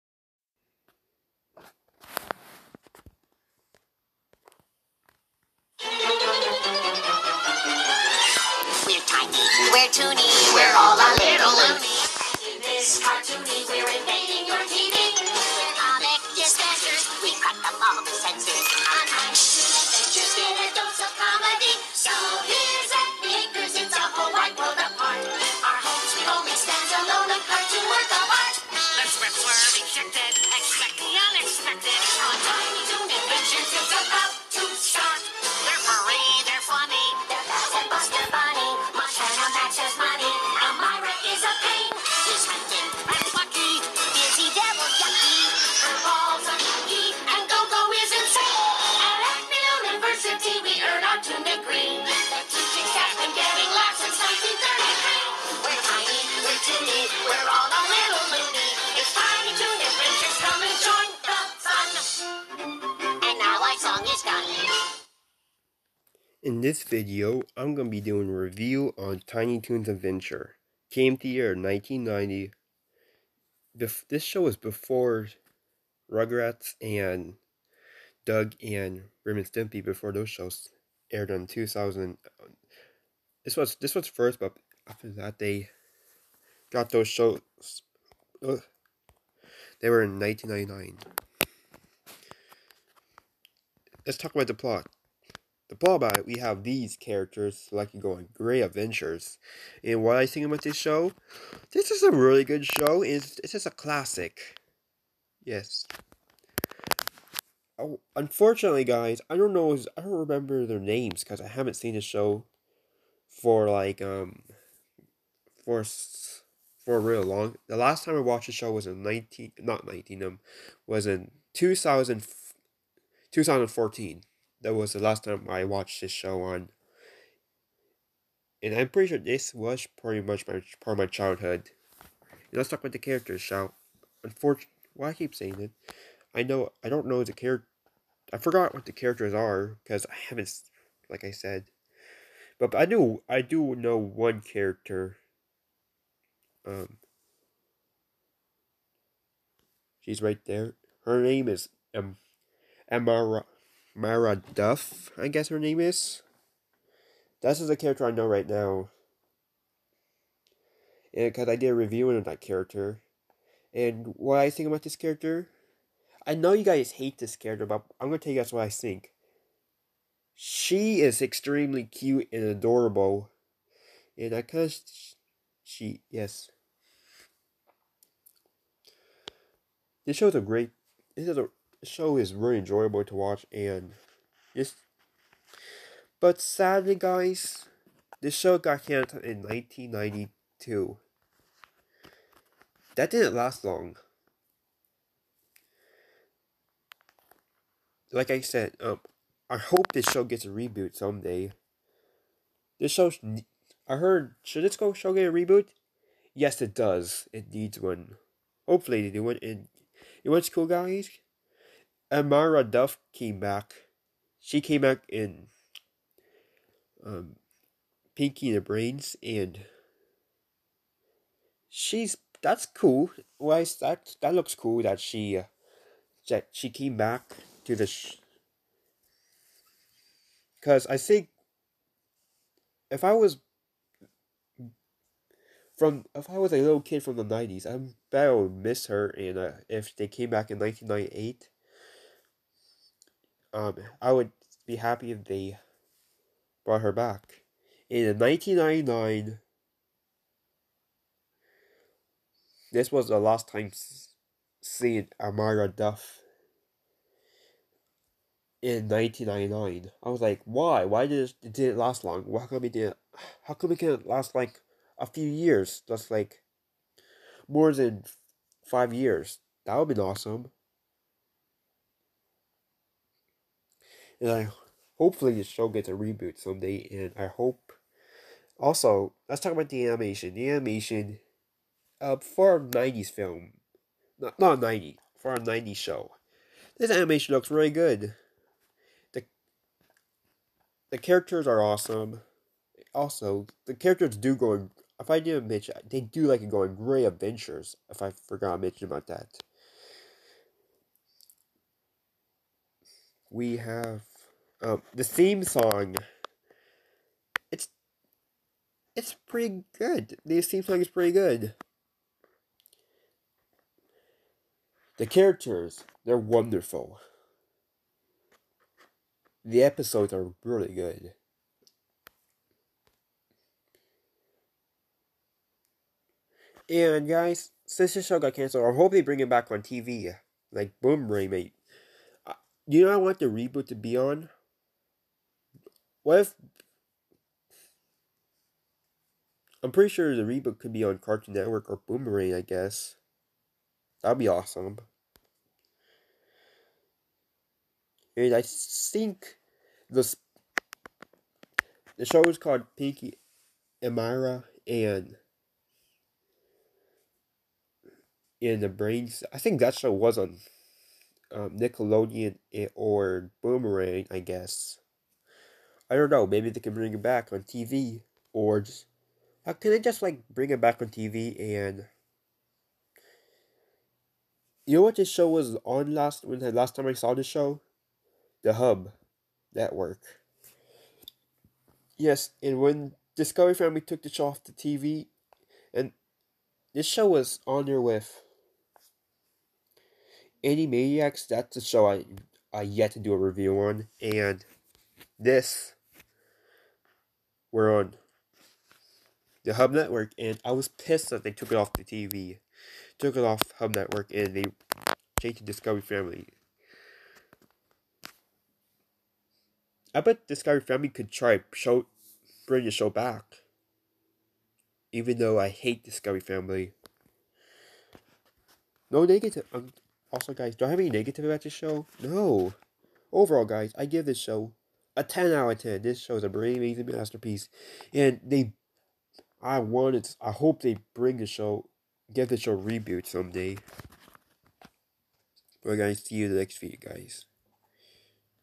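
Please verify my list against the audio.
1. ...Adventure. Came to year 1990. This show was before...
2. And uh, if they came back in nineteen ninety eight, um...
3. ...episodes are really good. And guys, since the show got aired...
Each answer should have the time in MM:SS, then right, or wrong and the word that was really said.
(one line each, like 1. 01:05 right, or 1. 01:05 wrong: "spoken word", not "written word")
1. 01:09 right
2. 03:59 right
3. 05:19 wrong: "canceled", not "aired".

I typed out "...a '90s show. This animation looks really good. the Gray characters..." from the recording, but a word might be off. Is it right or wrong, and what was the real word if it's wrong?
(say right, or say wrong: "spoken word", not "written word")
wrong: "The", not "Gray".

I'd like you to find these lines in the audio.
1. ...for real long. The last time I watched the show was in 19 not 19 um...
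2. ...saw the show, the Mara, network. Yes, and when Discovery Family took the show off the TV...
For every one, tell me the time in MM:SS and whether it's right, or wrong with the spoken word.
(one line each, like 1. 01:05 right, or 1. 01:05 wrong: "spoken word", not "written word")
1. 01:56 right
2. 06:16 wrong: "Hub", not "Mara".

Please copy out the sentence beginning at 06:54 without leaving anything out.
Even though I hate Discovery Family.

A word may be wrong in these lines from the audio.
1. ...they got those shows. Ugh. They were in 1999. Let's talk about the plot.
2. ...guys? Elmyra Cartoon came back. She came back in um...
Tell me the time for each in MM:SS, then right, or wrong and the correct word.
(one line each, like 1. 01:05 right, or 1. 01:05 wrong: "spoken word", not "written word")
1. 01:25 right
2. 03:30 wrong: "Duff", not "Cartoon".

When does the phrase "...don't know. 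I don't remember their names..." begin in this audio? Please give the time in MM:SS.
01:49.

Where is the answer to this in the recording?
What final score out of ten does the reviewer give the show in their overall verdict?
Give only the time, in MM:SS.
07:05.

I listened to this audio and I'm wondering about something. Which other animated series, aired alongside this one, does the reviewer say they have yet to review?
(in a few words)
Animaniacs.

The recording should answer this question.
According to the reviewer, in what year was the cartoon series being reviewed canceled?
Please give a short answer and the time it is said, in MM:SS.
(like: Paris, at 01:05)
1992, at 03:09.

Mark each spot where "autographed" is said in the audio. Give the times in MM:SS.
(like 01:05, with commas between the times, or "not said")
not said.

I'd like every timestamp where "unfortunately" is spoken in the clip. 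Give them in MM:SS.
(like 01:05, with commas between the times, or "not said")
01:48, 02:14.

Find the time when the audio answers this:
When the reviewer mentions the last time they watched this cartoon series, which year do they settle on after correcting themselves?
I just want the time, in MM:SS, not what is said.
02:03.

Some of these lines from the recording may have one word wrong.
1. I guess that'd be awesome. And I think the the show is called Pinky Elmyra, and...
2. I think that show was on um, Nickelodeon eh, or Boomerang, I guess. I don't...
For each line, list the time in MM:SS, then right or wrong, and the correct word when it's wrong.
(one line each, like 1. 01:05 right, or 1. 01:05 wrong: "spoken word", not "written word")
1. 05:42 right
2. 05:59 right.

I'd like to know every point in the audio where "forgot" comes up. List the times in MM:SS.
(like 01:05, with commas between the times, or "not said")
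02:18, 04:58.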